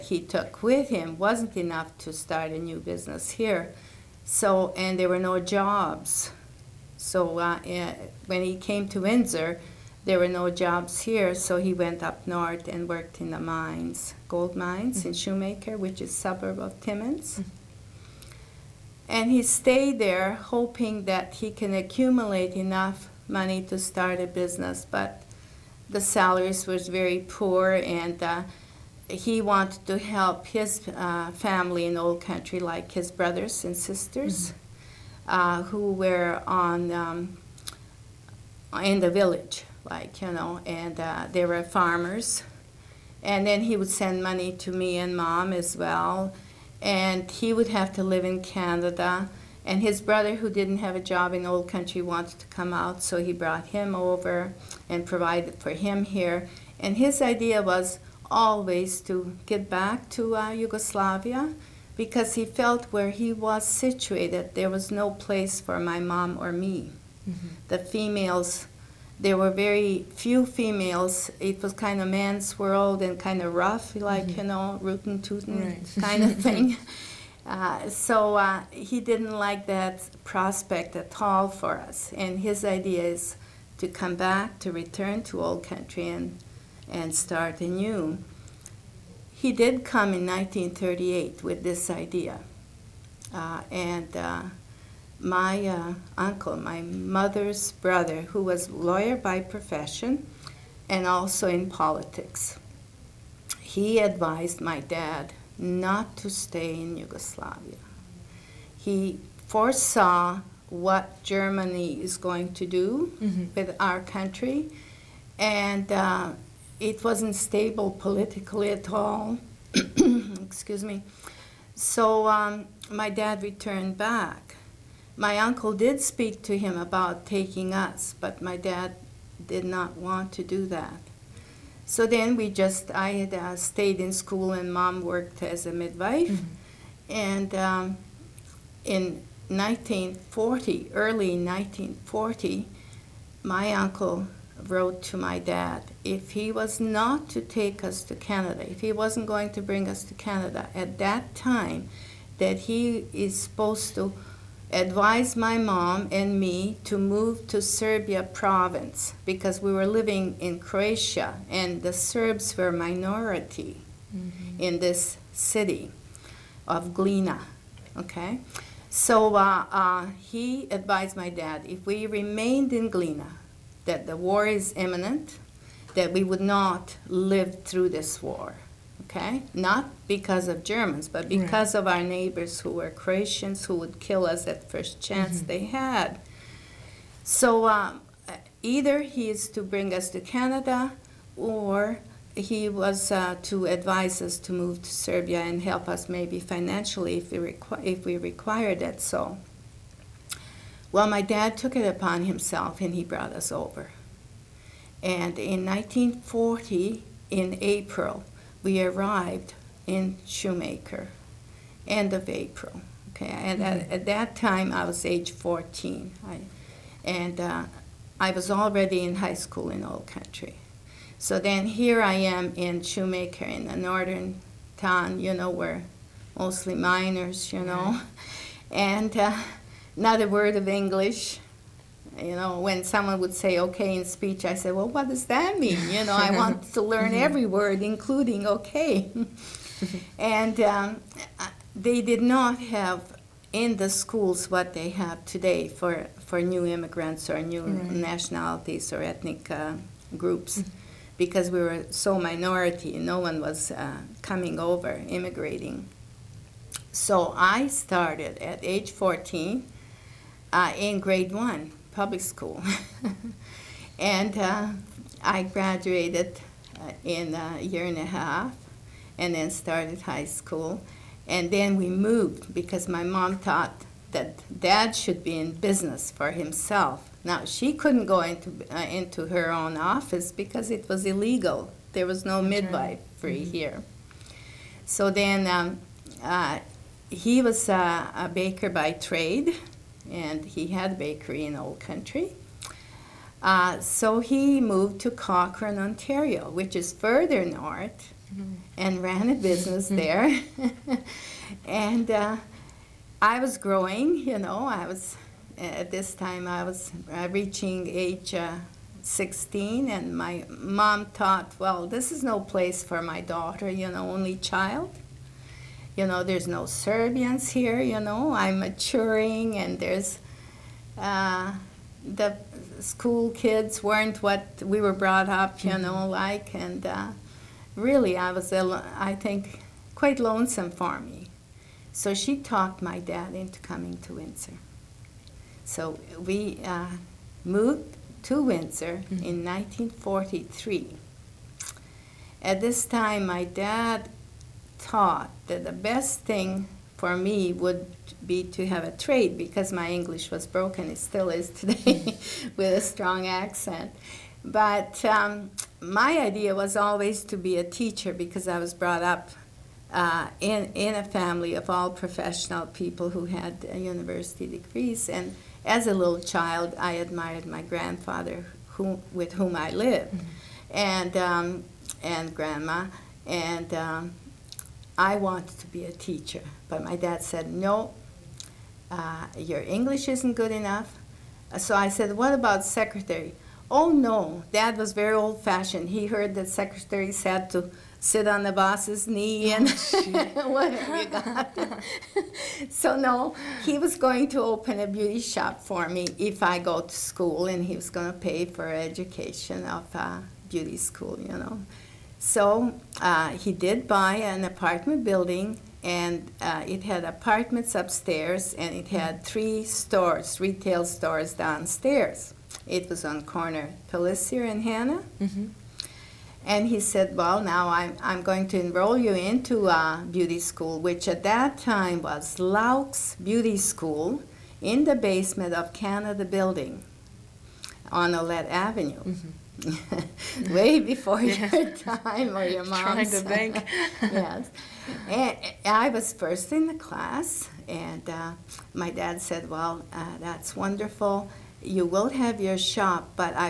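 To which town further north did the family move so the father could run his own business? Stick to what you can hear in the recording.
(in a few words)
Cochrane, Ontario.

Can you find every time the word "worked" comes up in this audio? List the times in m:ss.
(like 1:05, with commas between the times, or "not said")
0:12, 2:15.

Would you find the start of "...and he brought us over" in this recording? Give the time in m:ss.
3:22.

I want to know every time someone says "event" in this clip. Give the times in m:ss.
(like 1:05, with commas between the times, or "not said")
not said.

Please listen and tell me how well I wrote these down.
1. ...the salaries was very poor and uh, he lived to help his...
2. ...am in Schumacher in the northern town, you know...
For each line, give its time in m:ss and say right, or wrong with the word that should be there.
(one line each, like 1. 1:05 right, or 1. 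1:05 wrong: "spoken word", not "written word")
1. 0:25 wrong: "wanted", not "lived"
2. 3:42 right.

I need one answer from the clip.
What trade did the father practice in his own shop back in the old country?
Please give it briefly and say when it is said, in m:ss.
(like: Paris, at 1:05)
Baker, at 4:48.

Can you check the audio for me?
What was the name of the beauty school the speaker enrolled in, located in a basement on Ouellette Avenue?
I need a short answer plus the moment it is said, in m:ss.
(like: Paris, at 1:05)
Laux Beauty School, at 7:02.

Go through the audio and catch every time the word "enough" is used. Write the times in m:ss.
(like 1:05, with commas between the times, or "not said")
0:01, 0:22, 6:20.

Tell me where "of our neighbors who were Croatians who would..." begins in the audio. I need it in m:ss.
3:01.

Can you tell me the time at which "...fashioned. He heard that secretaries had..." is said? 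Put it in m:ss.
6:25.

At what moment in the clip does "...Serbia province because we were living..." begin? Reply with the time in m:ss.
2:37.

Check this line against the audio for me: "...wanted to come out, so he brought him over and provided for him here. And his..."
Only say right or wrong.
right.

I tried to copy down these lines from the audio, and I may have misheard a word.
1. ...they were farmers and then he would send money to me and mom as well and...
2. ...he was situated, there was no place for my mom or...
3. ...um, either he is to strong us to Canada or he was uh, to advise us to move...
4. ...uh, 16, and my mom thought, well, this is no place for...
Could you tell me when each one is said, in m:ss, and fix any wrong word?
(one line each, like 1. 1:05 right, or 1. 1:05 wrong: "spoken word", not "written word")
1. 0:41 right
2. 1:03 right
3. 3:07 wrong: "bring", not "strong"
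4. 5:08 right.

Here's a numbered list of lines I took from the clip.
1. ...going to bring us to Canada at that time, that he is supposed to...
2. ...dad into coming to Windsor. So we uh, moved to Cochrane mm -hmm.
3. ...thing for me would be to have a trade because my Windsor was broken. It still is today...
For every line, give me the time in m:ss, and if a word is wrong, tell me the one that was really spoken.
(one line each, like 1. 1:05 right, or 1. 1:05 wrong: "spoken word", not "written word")
1. 2:29 right
2. 5:33 wrong: "Windsor", not "Cochrane"
3. 5:46 wrong: "English", not "Windsor".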